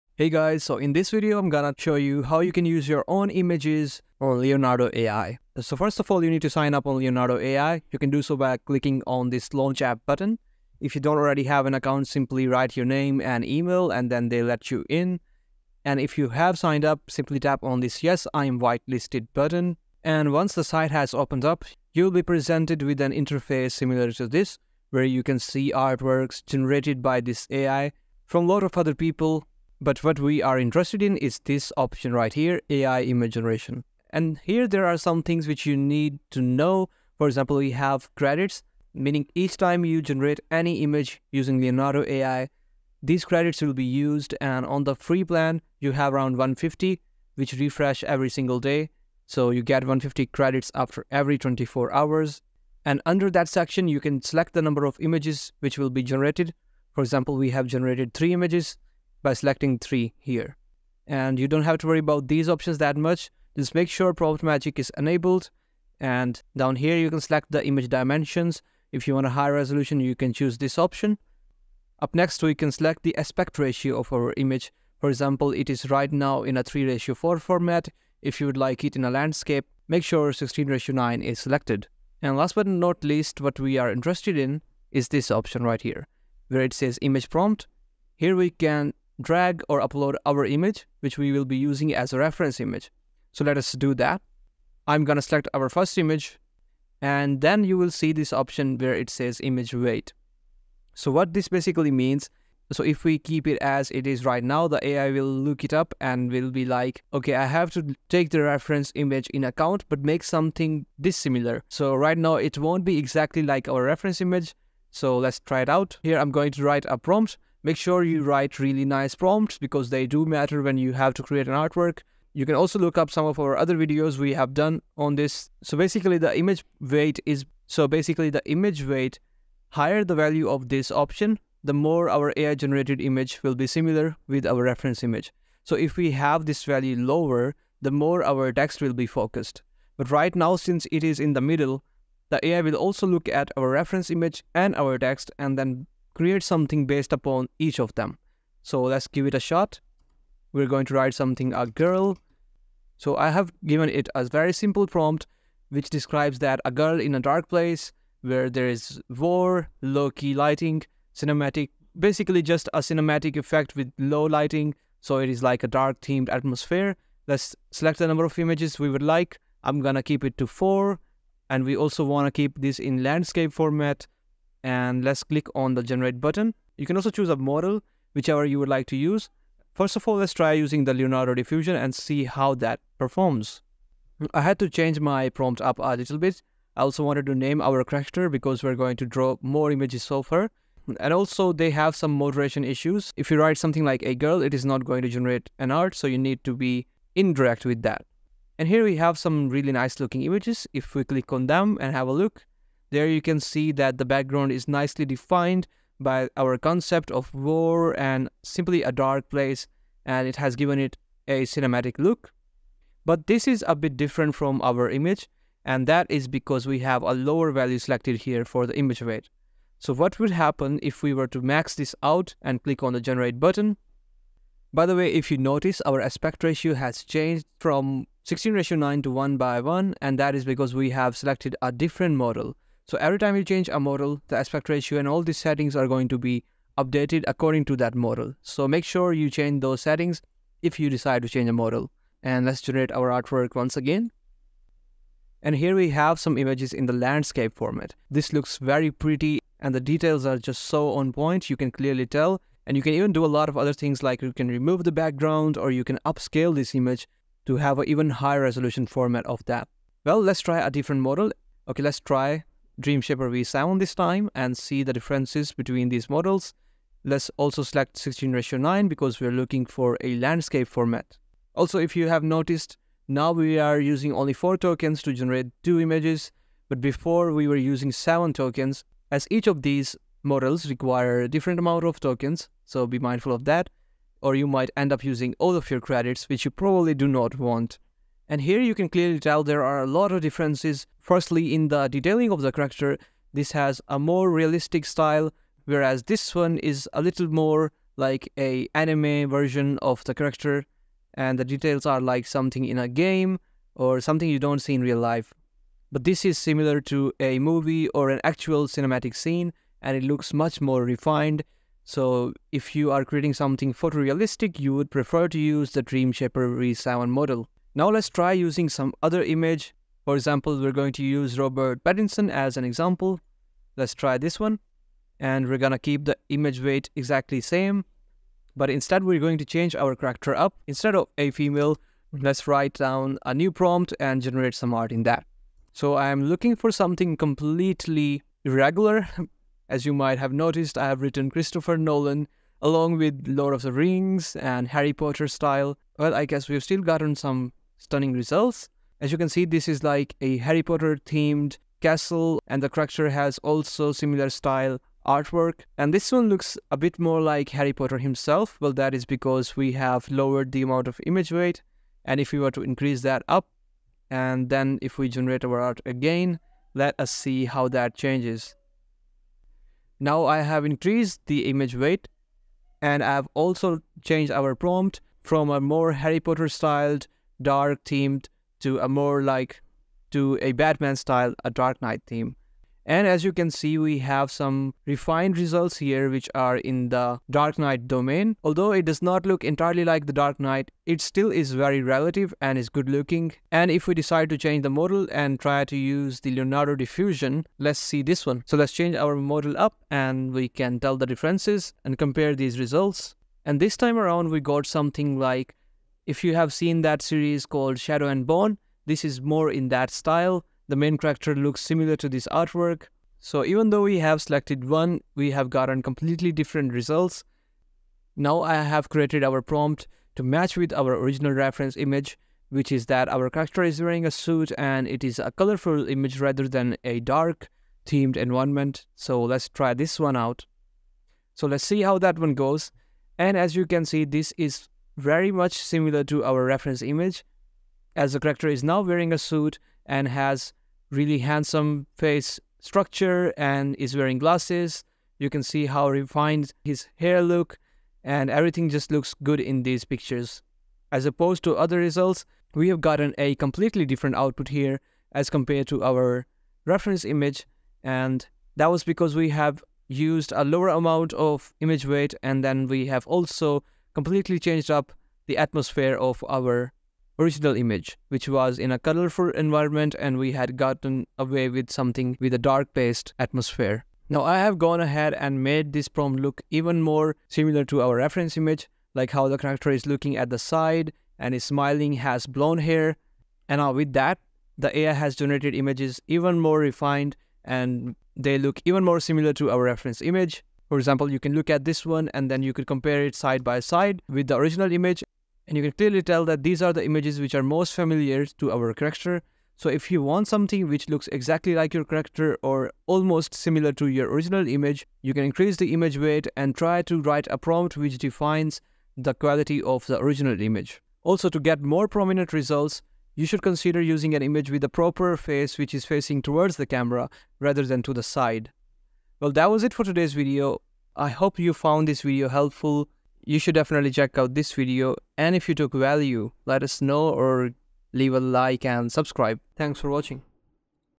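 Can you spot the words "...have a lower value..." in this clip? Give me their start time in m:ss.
3:36.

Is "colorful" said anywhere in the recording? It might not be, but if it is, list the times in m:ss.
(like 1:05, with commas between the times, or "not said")
7:05, 7:48.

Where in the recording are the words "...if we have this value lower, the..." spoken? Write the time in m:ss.
2:15.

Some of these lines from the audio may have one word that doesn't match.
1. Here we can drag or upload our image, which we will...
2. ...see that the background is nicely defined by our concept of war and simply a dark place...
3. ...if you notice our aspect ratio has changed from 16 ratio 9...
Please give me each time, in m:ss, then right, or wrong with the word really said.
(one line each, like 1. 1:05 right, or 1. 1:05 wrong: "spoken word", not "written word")
1. 1:28 right
2. 3:23 right
3. 3:45 right.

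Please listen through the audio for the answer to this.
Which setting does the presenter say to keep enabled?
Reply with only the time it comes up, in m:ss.
1:04.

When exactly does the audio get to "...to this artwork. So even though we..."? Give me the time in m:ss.
6:51.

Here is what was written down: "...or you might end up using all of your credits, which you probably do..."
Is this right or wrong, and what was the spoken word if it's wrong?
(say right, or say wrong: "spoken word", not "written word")
right.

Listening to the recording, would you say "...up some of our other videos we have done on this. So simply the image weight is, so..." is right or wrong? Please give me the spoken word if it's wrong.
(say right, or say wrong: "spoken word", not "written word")
wrong: "basically", not "simply".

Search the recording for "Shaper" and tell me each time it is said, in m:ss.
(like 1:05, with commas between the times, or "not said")
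4:23, 5:16.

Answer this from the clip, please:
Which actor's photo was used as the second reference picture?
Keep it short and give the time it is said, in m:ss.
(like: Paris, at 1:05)
Robert Pattinson, at 5:21.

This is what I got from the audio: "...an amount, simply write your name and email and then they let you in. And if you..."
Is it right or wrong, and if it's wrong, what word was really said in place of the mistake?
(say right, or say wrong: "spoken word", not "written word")
wrong: "account", not "amount".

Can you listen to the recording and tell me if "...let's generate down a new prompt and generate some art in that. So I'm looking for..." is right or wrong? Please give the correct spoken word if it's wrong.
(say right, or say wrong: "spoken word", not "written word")
wrong: "write", not "generate".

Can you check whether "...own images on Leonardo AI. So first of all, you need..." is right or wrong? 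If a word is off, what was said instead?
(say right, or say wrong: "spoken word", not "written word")
right.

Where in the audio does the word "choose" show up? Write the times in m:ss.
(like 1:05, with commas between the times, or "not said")
1:10, 2:57.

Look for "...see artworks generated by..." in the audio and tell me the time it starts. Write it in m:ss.
0:25.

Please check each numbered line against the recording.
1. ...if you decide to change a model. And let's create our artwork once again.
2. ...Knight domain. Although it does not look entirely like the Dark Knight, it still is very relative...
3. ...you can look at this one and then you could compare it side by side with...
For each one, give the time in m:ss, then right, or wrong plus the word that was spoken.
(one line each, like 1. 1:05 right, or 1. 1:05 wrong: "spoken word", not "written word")
1. 4:00 wrong: "generate", not "create"
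2. 6:27 right
3. 8:11 right.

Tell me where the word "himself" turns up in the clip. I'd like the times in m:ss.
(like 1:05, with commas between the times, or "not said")
5:57.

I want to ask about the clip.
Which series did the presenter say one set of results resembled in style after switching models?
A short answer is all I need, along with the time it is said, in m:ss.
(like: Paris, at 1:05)
Shadow and Bone, at 6:47.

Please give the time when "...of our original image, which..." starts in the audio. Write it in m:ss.
7:45.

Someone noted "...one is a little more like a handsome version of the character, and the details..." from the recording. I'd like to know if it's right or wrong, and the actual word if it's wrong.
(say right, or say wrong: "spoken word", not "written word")
wrong: "anime", not "handsome".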